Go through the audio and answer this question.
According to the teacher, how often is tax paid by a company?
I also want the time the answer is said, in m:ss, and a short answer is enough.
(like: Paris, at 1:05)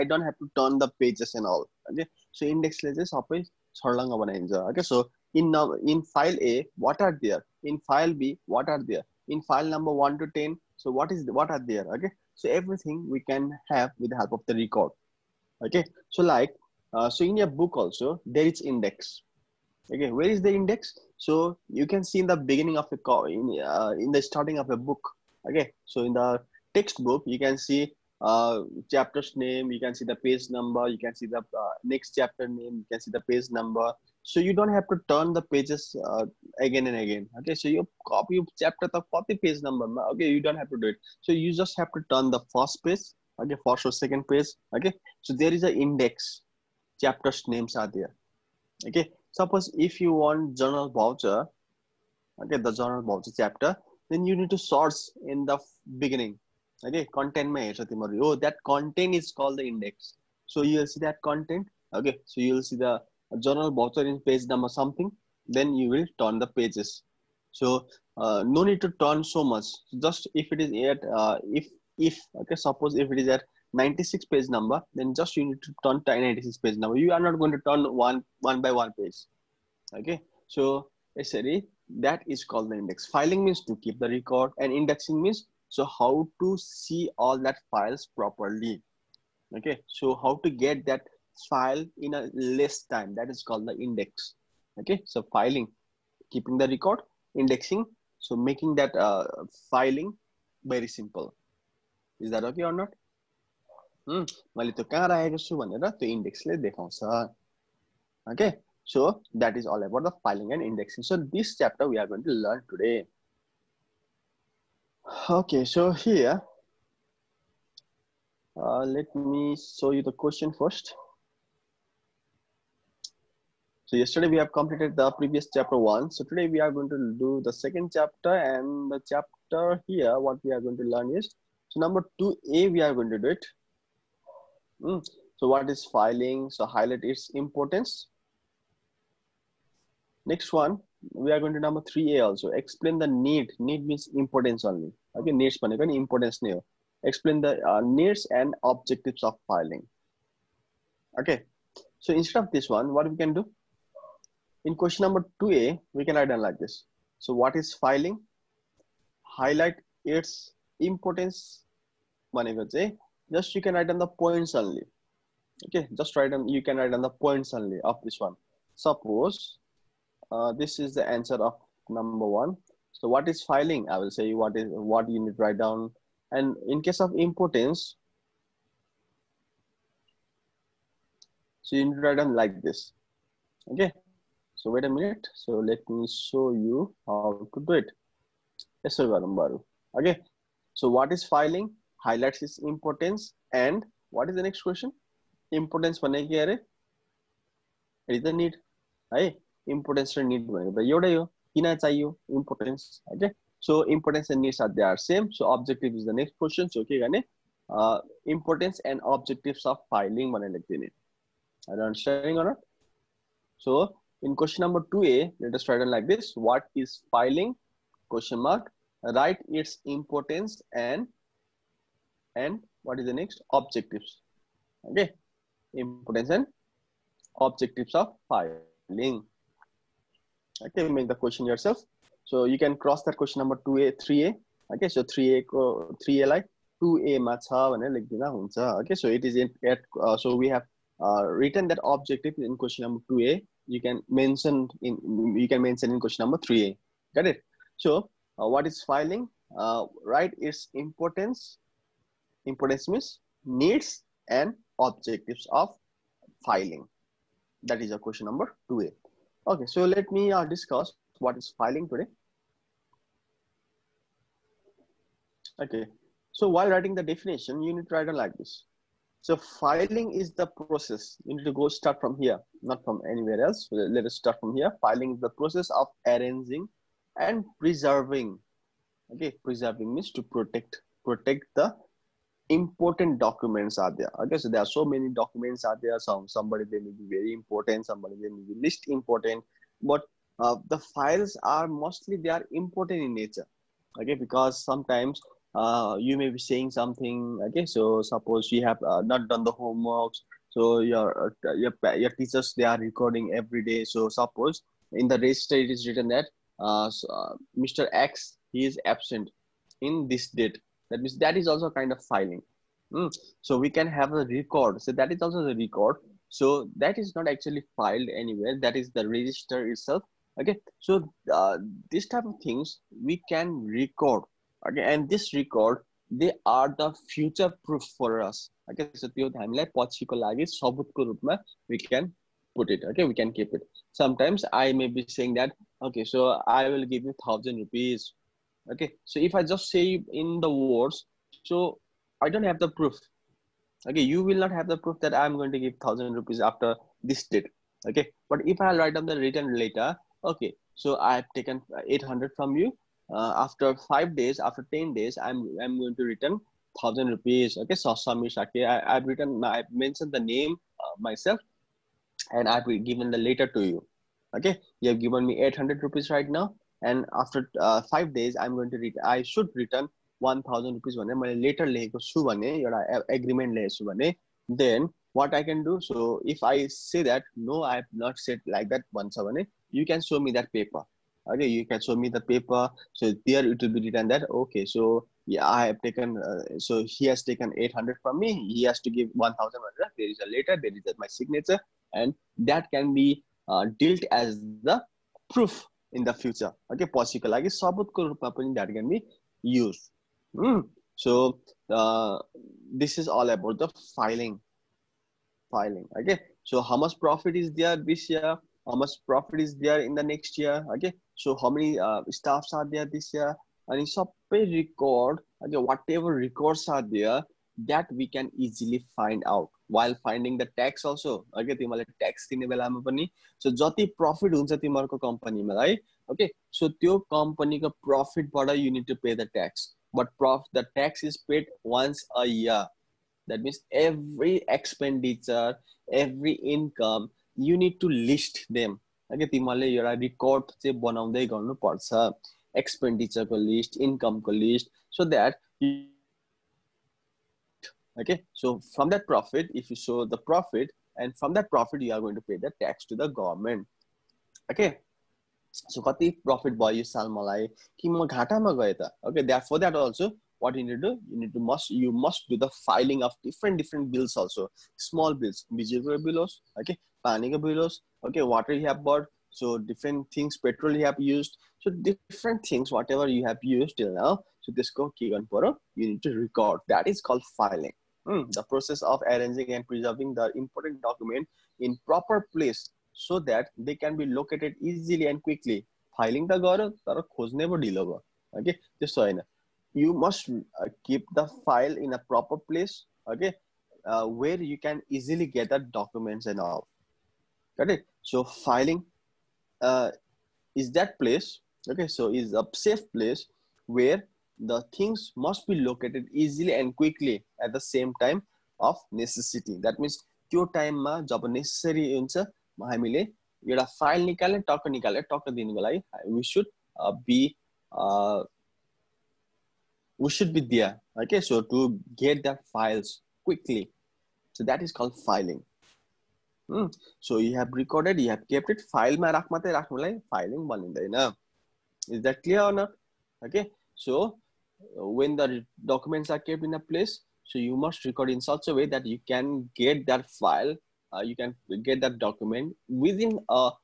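Once a year, at 7:11.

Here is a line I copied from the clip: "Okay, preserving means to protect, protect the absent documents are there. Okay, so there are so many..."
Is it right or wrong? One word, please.
wrong.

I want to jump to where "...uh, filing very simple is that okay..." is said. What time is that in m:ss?
1:38.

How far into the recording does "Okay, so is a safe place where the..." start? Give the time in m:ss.
8:21.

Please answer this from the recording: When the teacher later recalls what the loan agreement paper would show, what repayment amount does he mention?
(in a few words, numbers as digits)
1100.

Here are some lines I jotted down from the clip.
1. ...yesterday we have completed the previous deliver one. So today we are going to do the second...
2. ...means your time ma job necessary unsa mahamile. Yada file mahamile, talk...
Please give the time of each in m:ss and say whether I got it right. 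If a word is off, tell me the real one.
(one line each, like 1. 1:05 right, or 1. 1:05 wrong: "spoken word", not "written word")
1. 2:03 wrong: "chapter", not "deliver"
2. 8:29 wrong: "nikale", not "mahamile".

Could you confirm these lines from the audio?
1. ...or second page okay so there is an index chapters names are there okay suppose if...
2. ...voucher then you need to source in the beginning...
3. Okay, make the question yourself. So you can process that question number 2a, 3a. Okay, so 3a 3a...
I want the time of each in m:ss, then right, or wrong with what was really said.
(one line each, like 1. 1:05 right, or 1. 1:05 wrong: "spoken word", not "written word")
1. 0:43 right
2. 0:53 wrong: "chapter", not "voucher"
3. 3:50 wrong: "cross", not "process".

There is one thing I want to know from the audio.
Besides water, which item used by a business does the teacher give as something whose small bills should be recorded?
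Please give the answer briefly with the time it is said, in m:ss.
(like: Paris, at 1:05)
Petrol, at 7:50.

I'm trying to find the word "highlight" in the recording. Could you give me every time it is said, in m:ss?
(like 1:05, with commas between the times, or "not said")
2:16, 2:39, 3:12.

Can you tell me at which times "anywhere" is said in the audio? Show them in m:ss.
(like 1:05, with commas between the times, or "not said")
4:33, 5:18.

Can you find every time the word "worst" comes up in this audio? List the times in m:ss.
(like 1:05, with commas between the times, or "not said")
not said.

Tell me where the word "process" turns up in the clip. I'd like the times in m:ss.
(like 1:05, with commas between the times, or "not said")
4:30, 4:35, 7:58.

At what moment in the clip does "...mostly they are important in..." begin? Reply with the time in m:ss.
4:51.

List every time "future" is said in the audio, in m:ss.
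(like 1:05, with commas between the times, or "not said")
5:27, 6:36.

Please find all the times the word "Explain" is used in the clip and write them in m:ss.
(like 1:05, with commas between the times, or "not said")
2:22, 2:27.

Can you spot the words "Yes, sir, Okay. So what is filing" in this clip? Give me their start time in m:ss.
3:08.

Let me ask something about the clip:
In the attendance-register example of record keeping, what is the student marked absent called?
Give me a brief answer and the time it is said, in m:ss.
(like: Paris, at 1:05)
Mr X, at 5:07.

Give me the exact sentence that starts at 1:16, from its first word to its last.
You are not going to turn one one by one page.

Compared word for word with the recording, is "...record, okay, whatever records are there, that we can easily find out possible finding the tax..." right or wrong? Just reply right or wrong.
wrong.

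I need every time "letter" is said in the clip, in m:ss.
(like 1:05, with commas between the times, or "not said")
6:03, 6:11, 6:30.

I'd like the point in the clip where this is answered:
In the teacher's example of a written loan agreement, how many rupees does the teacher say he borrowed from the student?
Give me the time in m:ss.
5:51.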